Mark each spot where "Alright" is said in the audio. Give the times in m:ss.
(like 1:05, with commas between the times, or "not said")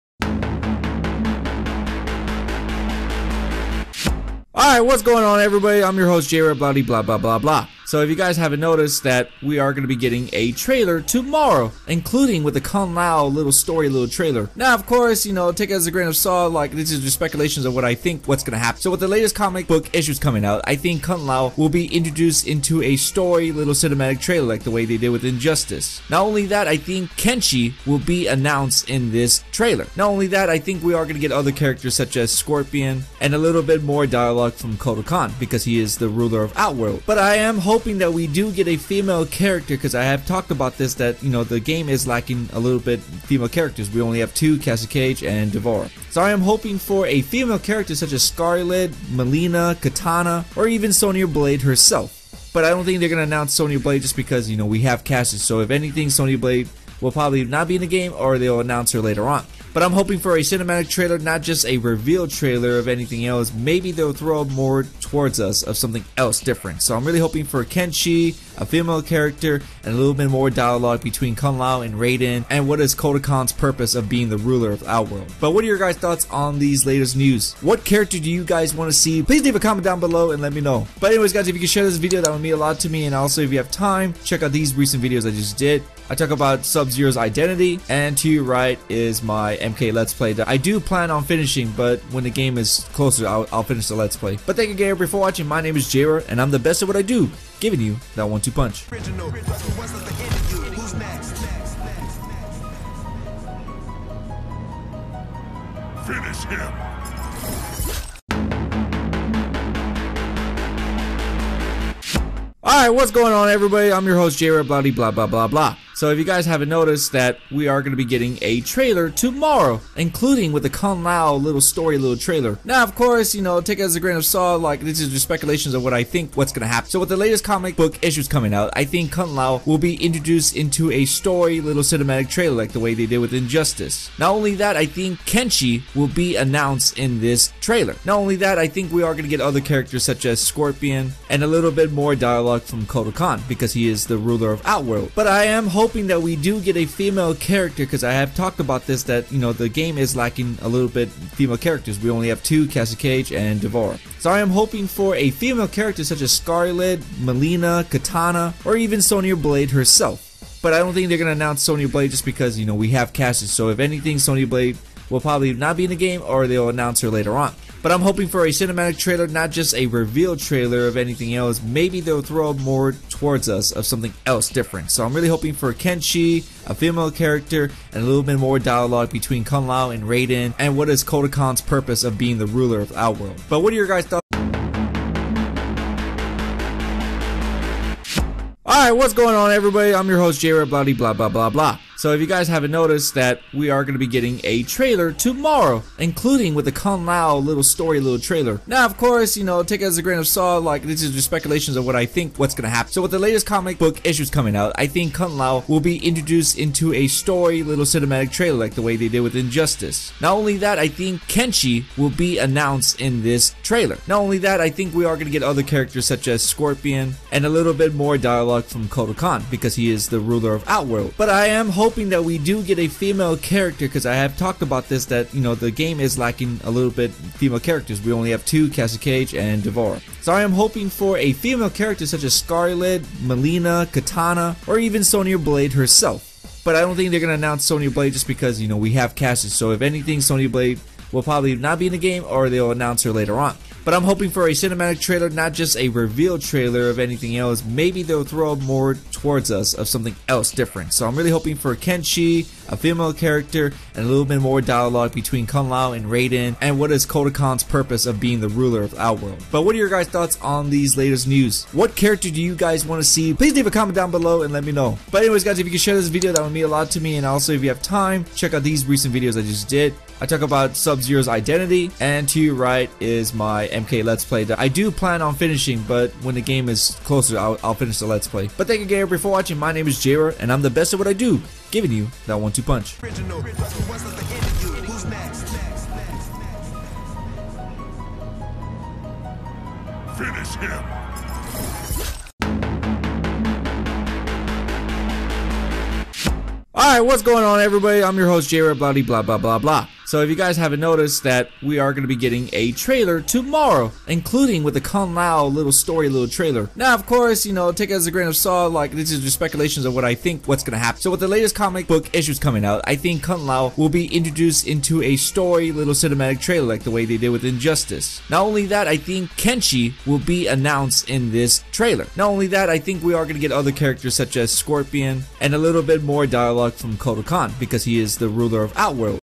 1:52, 3:08, 4:56.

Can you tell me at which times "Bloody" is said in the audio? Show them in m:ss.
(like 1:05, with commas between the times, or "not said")
0:06.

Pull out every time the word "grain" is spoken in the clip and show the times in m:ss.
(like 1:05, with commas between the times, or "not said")
0:15, 2:03, 3:20, 5:08.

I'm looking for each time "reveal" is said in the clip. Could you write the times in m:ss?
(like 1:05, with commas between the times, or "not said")
1:01, 2:49, 4:05.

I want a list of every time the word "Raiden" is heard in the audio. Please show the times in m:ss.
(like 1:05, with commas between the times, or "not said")
1:11, 3:00, 4:16.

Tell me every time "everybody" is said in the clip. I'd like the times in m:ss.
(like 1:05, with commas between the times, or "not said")
0:05, 1:53, 3:09, 4:57.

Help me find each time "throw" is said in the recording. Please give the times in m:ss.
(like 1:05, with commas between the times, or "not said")
1:04, 2:52, 4:08.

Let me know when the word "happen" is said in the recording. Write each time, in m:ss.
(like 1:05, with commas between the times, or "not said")
0:18, 2:06, 3:22, 5:10.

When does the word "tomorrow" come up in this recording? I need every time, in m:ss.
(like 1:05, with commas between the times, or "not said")
0:11, 1:59, 3:15, 5:03.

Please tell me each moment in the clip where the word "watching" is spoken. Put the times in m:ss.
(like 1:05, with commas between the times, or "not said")
1:35, 4:39.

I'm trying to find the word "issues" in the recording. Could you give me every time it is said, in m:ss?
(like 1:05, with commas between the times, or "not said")
0:19, 2:08, 3:24, 5:12.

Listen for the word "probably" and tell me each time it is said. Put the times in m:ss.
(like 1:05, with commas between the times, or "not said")
0:57, 2:45, 4:01.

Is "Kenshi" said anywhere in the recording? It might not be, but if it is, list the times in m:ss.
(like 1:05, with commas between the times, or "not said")
0:27, 1:07, 2:15, 2:55, 3:31, 4:11, 5:19.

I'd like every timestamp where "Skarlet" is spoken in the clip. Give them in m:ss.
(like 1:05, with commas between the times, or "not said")
0:48, 2:36, 3:52.